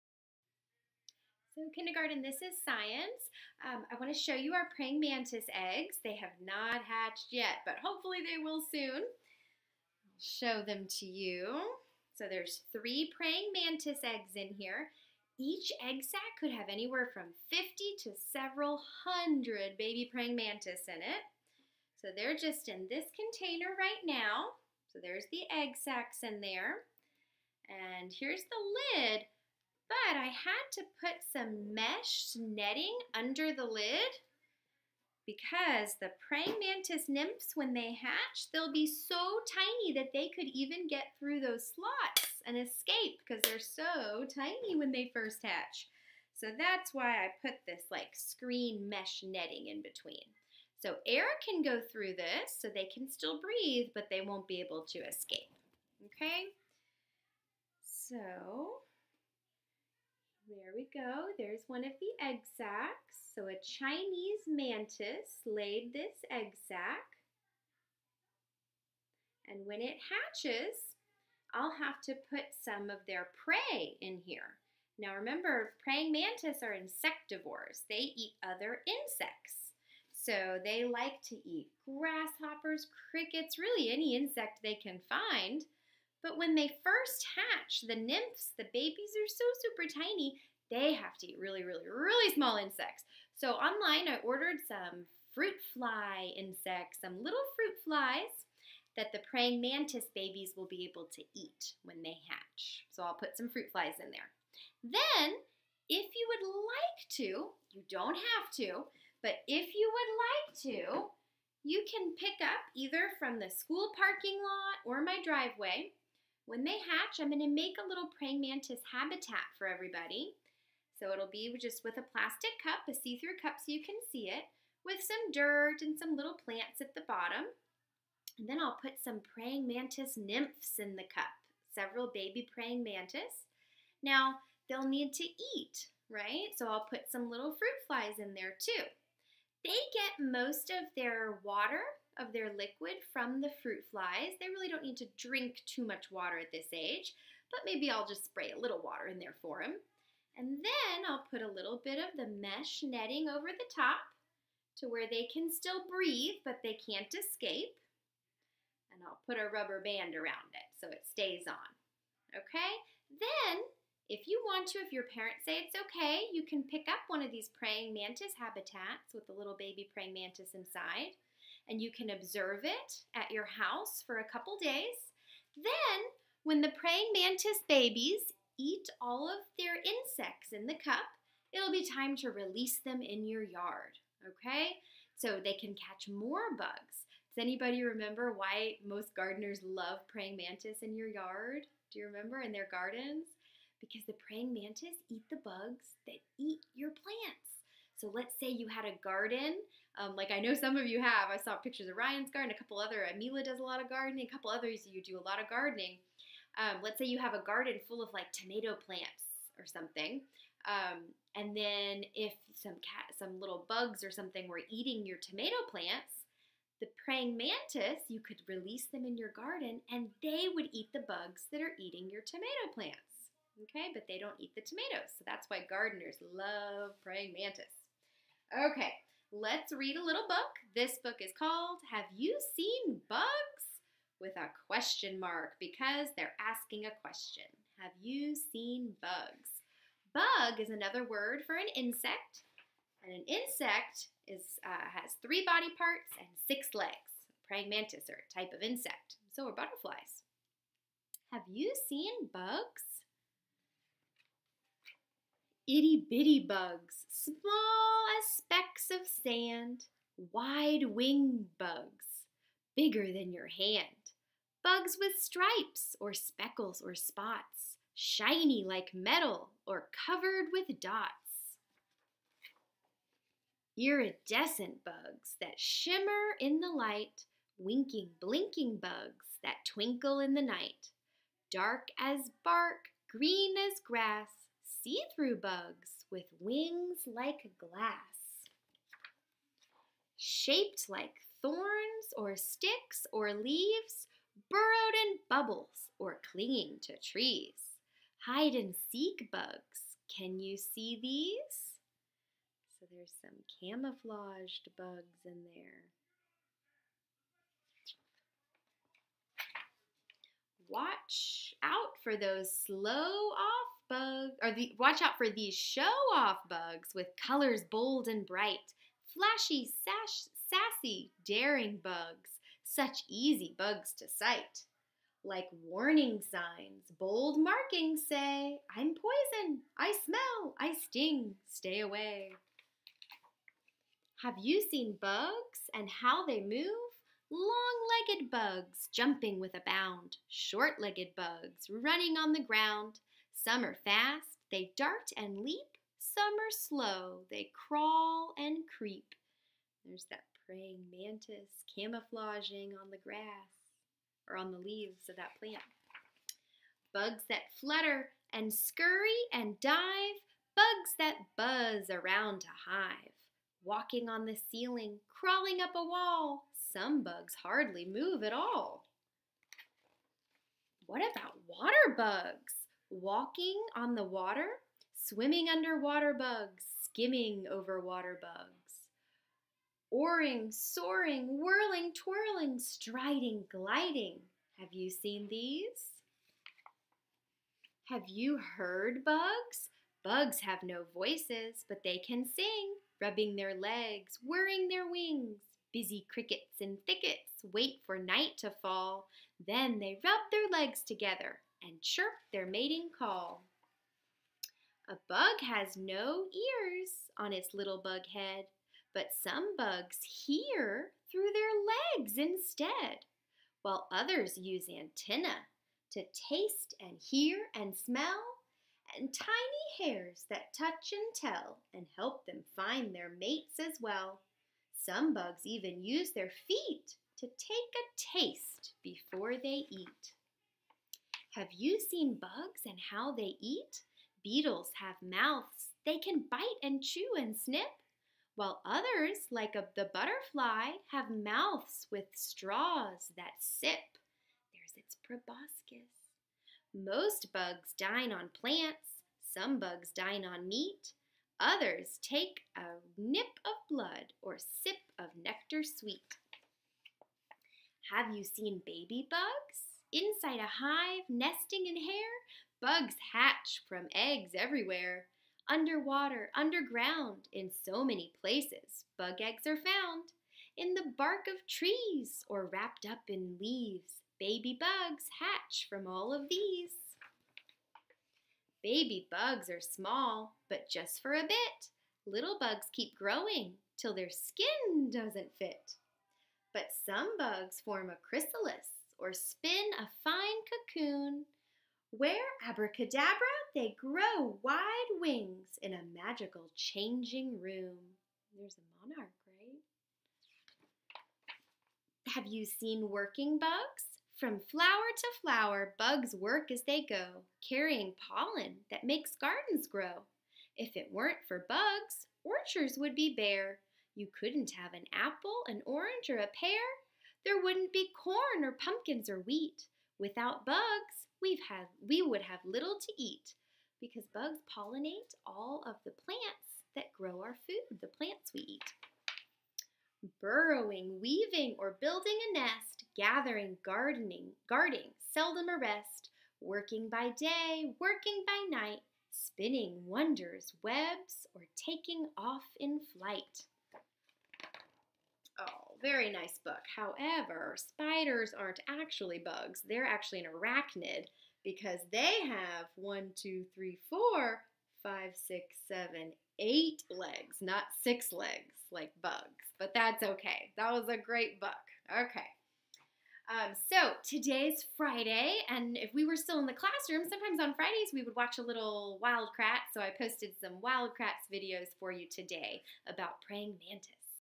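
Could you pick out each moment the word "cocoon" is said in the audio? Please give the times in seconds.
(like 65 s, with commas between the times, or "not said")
490 s.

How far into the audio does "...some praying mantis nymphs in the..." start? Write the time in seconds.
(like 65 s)
129 s.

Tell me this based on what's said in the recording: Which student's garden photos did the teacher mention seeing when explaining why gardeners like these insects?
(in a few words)
Ryan.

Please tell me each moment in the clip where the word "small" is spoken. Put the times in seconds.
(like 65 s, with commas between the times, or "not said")
92 s, 257 s, 479 s.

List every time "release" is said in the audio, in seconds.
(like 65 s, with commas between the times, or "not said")
182 s, 218 s.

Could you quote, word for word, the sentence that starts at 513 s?
You couldn't have an apple, an orange, or a pear there wouldn't be corn or pumpkins or wheat.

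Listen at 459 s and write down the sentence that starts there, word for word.
Inside a hive, nesting in hair, bugs hatch from eggs everywhere.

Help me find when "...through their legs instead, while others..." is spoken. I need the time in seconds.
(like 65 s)
411 s.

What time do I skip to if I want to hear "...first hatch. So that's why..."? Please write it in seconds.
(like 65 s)
45 s.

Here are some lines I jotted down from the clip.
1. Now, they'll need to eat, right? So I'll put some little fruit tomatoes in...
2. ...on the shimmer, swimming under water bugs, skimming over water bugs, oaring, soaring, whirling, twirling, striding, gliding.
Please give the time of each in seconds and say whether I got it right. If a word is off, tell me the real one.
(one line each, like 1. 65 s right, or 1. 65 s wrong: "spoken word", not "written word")
1. 134 s wrong: "flies", not "tomatoes"
2. 373 s wrong: "water", not "shimmer".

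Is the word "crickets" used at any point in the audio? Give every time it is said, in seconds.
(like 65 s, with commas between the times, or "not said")
83 s, 396 s.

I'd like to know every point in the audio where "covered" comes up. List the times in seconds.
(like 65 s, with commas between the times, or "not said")
270 s.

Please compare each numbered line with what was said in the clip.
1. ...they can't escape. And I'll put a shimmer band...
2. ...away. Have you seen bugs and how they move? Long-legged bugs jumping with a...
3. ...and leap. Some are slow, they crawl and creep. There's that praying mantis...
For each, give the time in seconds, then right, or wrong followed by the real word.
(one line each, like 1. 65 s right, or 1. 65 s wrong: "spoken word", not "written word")
1. 156 s wrong: "rubber", not "shimmer"
2. 331 s right
3. 345 s right.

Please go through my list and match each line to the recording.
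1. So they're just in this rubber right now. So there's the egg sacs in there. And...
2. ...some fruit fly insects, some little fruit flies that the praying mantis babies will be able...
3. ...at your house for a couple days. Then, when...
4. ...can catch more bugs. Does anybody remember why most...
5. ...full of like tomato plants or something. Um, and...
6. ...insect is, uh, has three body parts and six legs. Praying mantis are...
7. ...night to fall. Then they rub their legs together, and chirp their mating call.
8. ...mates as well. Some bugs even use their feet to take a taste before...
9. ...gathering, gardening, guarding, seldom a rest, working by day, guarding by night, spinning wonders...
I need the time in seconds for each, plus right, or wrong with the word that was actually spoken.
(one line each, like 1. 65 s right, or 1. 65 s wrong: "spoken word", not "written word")
1. 21 s wrong: "container", not "rubber"
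2. 94 s right
3. 173 s right
4. 185 s right
5. 207 s right
6. 243 s right
7. 397 s right
8. 423 s right
9. 532 s wrong: "working", not "guarding".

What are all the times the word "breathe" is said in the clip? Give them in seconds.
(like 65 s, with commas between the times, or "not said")
53 s, 155 s.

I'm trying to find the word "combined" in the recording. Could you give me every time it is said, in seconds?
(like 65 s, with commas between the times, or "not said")
not said.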